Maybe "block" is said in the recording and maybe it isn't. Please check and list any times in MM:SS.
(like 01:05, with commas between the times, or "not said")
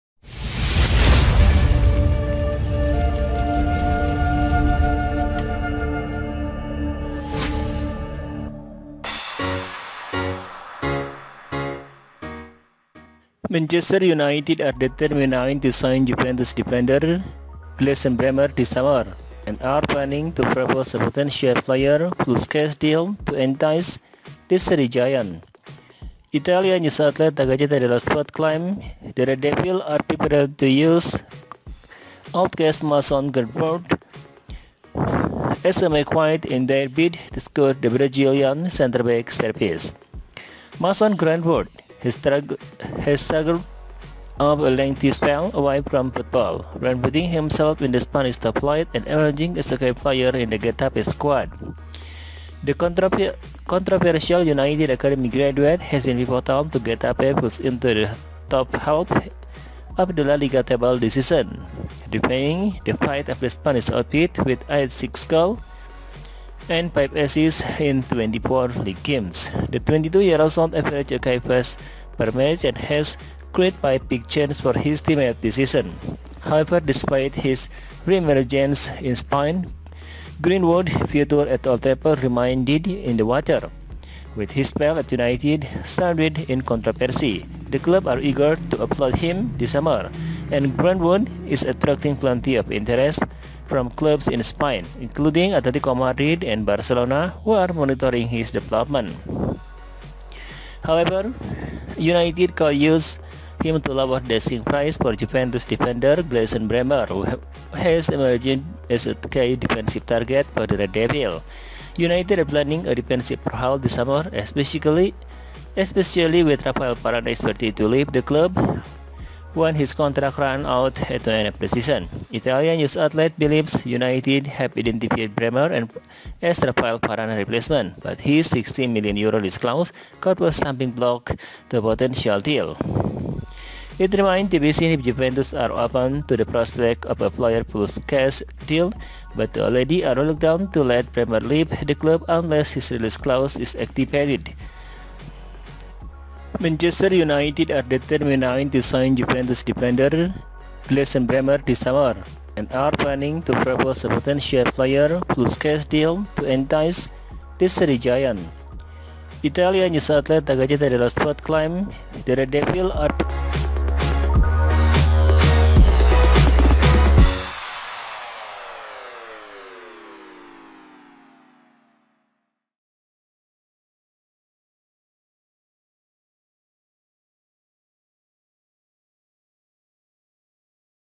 02:10.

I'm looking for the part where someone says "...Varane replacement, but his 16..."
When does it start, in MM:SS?
02:06.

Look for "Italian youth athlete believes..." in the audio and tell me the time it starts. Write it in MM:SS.
02:02.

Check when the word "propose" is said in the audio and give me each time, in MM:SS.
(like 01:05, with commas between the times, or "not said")
00:20, 02:33.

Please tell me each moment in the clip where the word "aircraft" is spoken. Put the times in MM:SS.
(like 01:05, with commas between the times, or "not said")
not said.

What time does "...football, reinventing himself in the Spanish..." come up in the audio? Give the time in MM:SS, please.
00:46.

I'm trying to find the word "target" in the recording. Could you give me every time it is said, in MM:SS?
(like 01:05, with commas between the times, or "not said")
01:50.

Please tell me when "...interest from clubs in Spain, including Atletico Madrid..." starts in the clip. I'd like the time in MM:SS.
01:32.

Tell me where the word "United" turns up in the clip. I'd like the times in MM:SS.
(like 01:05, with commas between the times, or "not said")
00:14, 00:54, 01:25, 01:41, 01:51, 02:03, 02:27.